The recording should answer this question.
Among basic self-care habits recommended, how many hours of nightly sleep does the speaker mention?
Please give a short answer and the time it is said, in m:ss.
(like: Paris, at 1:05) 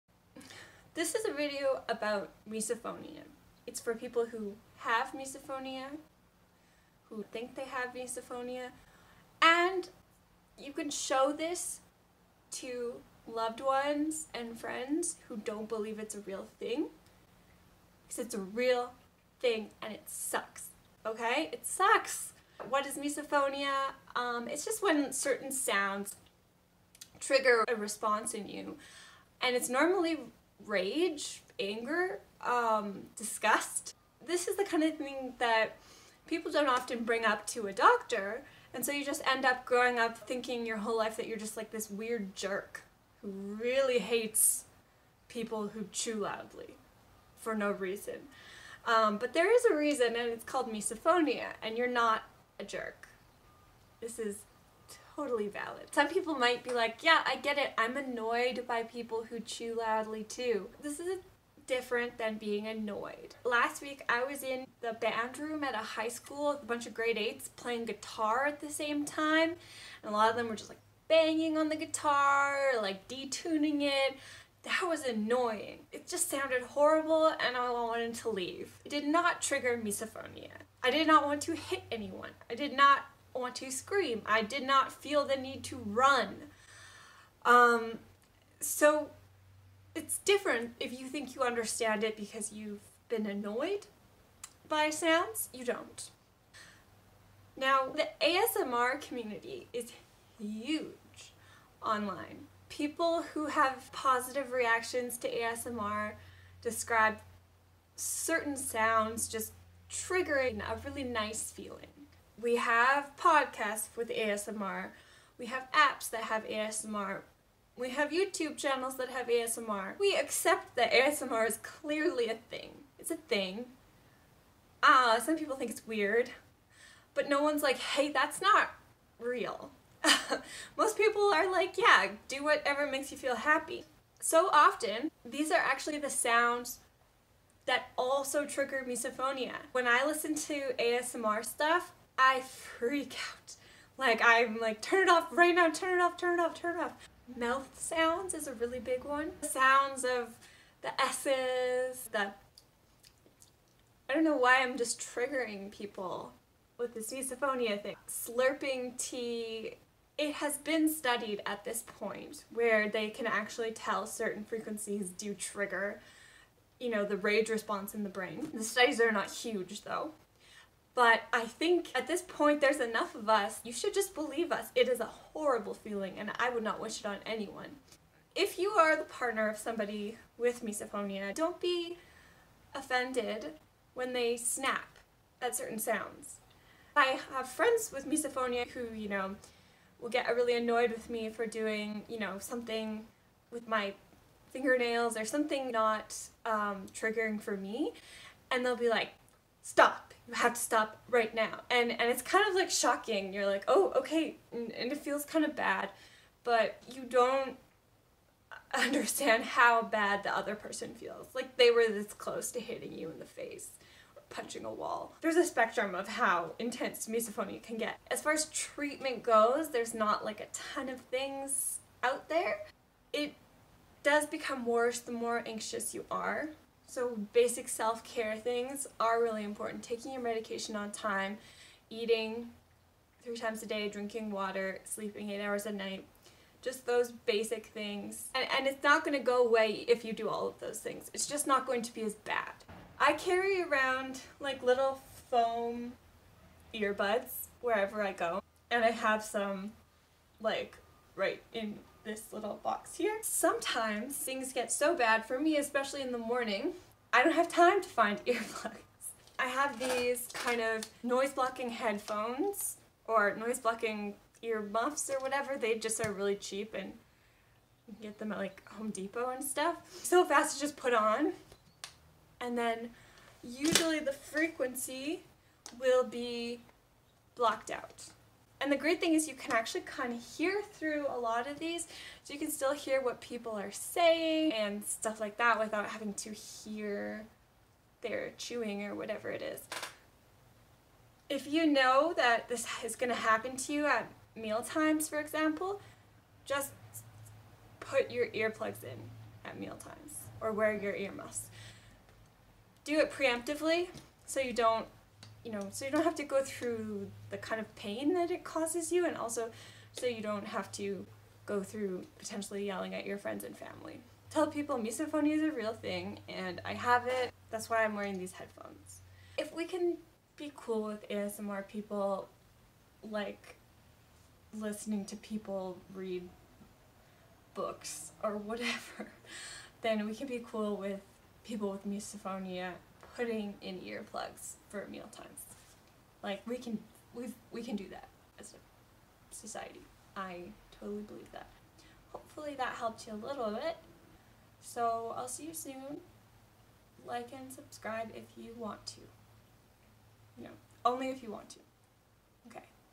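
8, at 3:55.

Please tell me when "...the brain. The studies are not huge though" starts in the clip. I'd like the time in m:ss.
2:48.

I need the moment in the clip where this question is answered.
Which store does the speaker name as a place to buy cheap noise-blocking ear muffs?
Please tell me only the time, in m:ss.
4:28.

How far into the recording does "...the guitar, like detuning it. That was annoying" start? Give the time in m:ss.
1:11.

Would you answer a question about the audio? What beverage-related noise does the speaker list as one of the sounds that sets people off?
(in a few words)
Slurping tea.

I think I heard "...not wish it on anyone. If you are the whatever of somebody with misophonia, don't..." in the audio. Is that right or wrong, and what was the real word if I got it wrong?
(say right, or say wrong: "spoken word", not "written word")
wrong: "partner", not "whatever".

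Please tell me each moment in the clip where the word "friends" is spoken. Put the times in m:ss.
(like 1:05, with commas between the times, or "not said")
0:14, 3:07, 5:13.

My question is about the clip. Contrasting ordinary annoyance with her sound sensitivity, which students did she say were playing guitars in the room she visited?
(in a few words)
grade 8s.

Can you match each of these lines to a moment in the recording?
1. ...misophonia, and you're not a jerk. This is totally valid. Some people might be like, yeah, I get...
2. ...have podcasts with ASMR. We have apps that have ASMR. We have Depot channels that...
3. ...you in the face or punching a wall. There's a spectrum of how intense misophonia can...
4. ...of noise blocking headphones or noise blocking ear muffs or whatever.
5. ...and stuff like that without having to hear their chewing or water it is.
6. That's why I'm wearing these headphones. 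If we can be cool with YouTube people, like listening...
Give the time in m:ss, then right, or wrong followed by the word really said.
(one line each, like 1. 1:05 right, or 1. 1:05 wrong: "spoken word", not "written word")
1. 0:50 right
2. 1:52 wrong: "YouTube", not "Depot"
3. 3:32 right
4. 4:20 right
5. 4:44 wrong: "whatever", not "water"
6. 5:17 wrong: "ASMR", not "YouTube".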